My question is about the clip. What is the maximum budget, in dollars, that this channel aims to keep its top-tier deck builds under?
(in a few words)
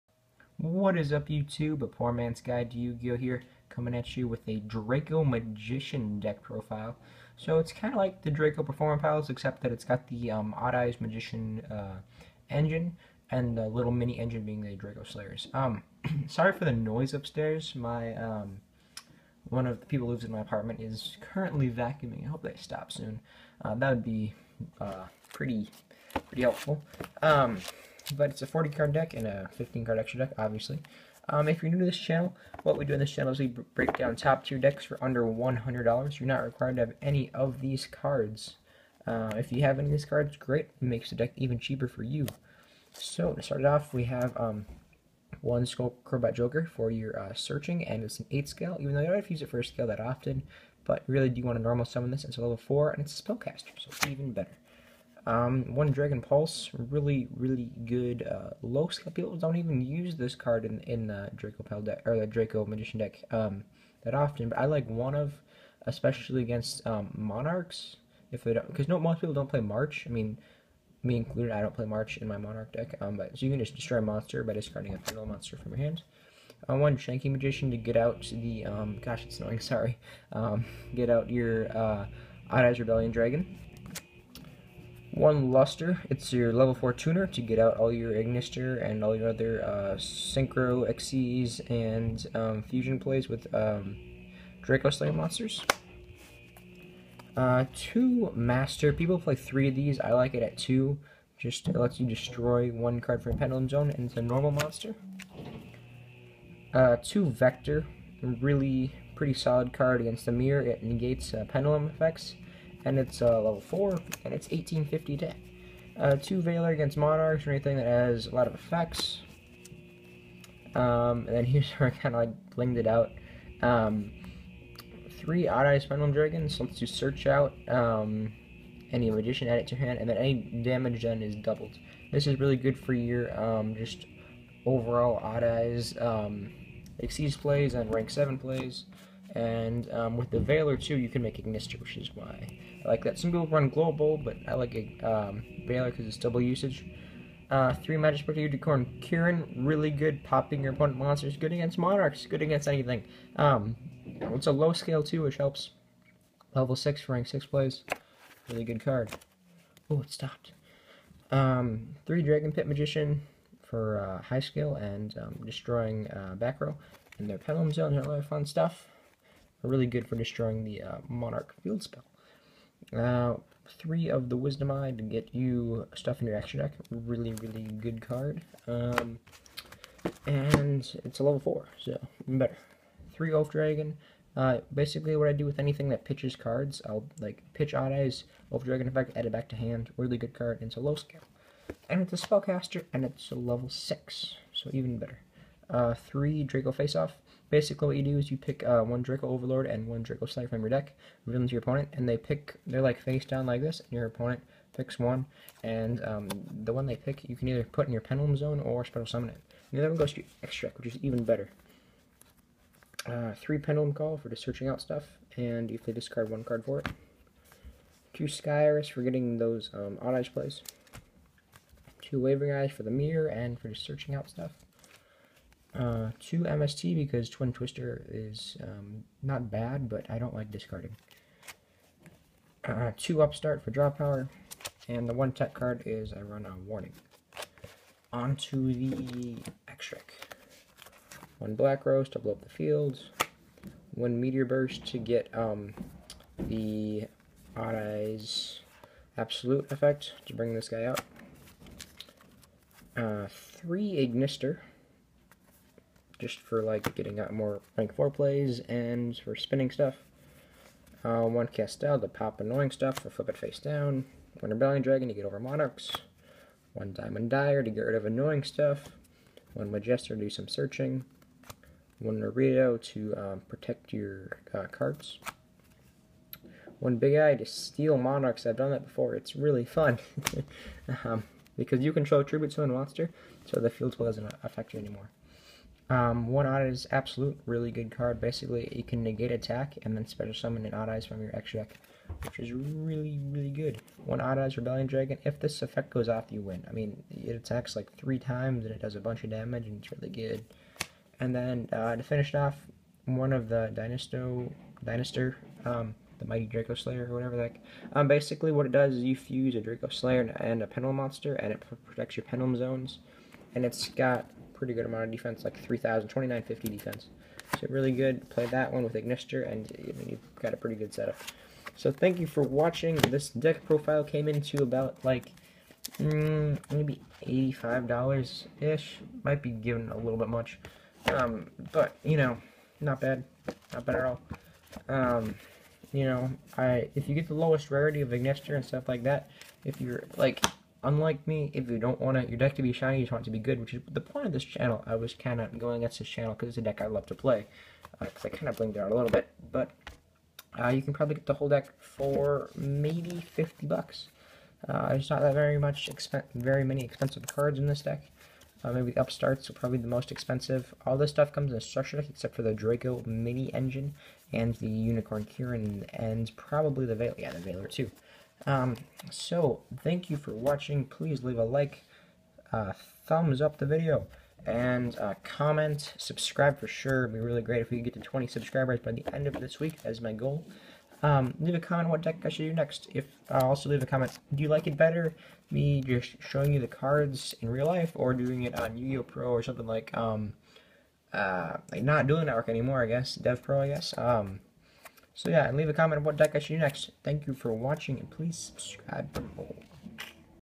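$100.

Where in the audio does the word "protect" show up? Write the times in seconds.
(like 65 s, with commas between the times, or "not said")
273 s, 311 s.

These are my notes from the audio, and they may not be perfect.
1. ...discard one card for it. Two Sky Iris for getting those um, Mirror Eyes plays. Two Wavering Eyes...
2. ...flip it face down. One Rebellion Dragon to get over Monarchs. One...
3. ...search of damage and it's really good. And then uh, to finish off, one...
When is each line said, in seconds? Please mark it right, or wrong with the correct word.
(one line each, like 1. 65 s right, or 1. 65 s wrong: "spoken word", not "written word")
1. 215 s wrong: "Odd", not "Mirror"
2. 263 s right
3. 299 s wrong: "bunch", not "search".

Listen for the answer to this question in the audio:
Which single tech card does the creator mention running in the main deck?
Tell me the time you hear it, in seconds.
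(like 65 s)
236 s.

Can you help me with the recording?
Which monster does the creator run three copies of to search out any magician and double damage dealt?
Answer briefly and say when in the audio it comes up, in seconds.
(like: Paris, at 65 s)
Odd-Eye Spinal Dragons, at 125 s.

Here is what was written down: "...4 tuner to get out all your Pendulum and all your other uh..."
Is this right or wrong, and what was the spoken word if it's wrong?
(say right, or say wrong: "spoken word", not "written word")
wrong: "Ignister", not "Pendulum".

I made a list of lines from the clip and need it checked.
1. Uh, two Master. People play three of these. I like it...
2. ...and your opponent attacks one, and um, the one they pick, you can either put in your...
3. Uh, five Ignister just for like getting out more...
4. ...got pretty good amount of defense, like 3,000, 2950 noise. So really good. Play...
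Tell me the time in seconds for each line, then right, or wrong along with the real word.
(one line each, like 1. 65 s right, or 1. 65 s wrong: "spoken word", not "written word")
1. 97 s right
2. 203 s wrong: "picks", not "attacks"
3. 252 s wrong: "three", not "five"
4. 313 s wrong: "defense", not "noise".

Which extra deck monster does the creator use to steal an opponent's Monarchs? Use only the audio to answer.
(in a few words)
Big Eye.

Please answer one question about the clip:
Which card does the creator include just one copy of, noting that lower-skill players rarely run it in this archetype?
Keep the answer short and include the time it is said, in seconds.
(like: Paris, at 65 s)
Dragon Pulse, at 55 s.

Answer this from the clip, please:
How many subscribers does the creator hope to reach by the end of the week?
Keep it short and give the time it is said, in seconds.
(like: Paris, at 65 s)
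20, at 377 s.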